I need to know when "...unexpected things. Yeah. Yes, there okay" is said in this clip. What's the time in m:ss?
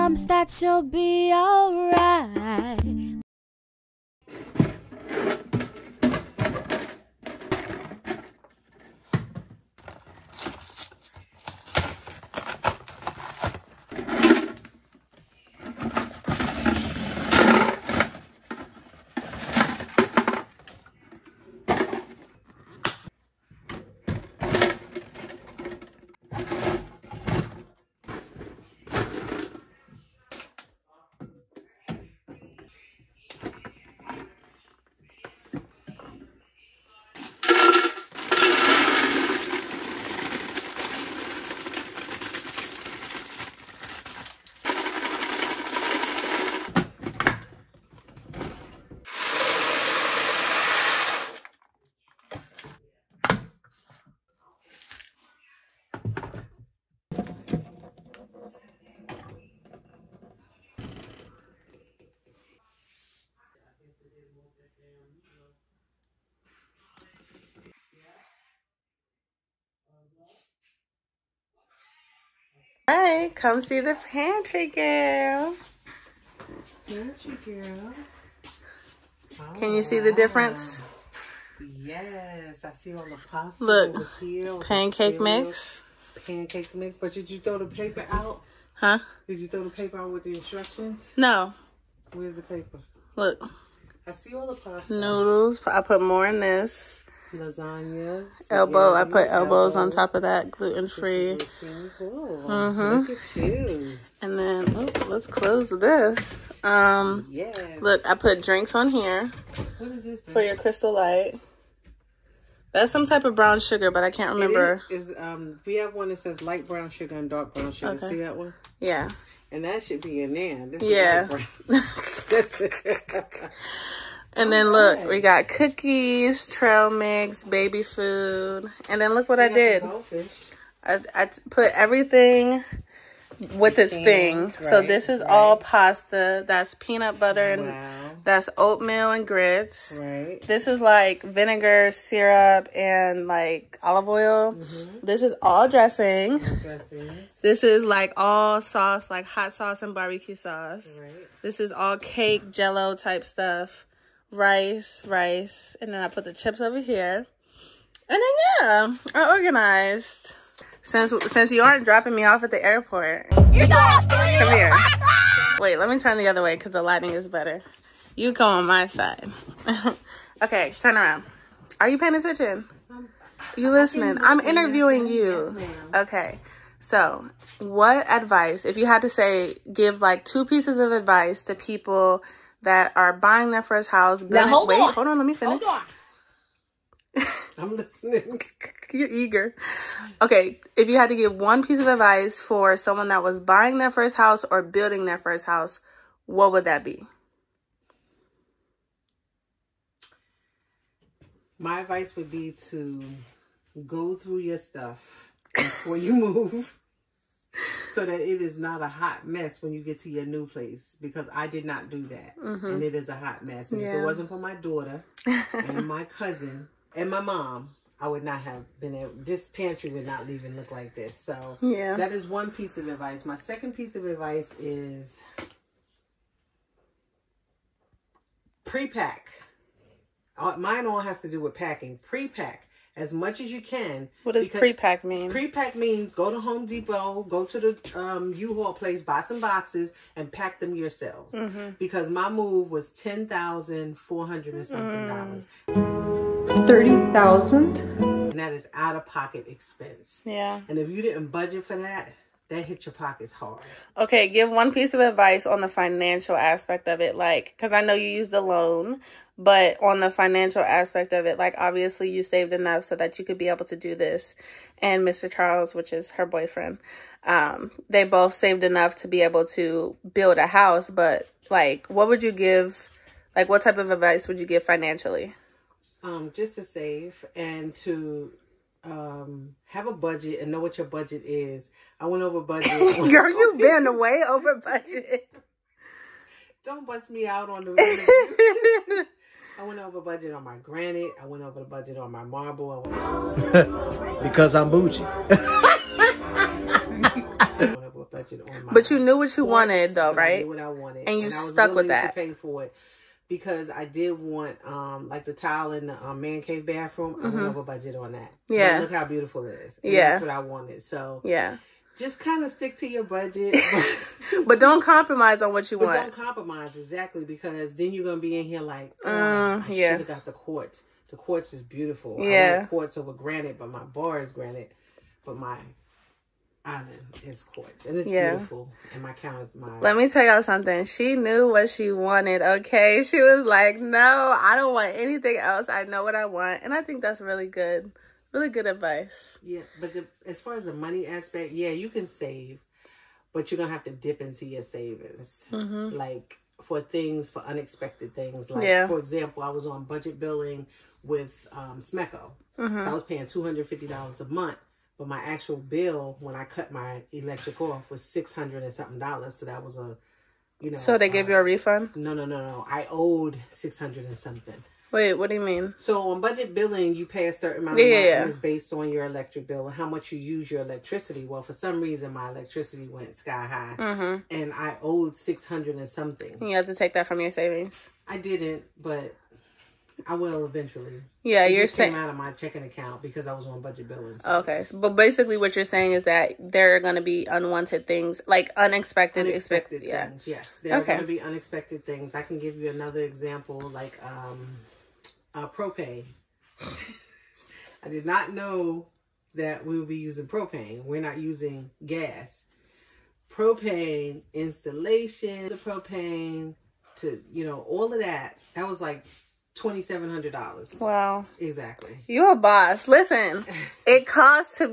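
6:29.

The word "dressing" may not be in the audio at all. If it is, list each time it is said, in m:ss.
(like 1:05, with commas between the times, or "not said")
2:25.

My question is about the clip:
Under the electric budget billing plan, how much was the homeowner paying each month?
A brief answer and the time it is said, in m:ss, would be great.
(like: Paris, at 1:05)
$250, at 5:53.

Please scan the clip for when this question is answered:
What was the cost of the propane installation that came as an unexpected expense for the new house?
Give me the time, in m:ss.
6:49.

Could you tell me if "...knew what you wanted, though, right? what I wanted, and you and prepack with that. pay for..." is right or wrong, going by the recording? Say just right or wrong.
wrong.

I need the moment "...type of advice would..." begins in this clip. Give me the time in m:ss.
4:33.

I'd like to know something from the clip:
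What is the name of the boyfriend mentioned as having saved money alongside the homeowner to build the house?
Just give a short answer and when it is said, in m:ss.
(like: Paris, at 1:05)
Mr. Charles, at 4:25.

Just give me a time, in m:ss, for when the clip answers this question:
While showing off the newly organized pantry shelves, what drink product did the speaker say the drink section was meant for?
1:50.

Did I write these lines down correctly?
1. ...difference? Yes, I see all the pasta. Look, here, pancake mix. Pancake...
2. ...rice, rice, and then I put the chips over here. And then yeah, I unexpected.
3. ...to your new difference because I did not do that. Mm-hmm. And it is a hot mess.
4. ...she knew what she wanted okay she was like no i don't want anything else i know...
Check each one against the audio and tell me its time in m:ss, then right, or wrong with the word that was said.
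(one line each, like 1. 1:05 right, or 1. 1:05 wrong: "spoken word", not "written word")
1. 1:20 right
2. 2:34 wrong: "organized", not "unexpected"
3. 3:29 wrong: "place", not "difference"
4. 5:30 right.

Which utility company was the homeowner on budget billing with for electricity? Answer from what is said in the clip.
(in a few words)
SMECO.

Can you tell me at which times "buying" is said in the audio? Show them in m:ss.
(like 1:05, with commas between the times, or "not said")
3:03, 3:13.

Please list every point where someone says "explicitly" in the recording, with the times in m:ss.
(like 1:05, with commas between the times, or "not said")
not said.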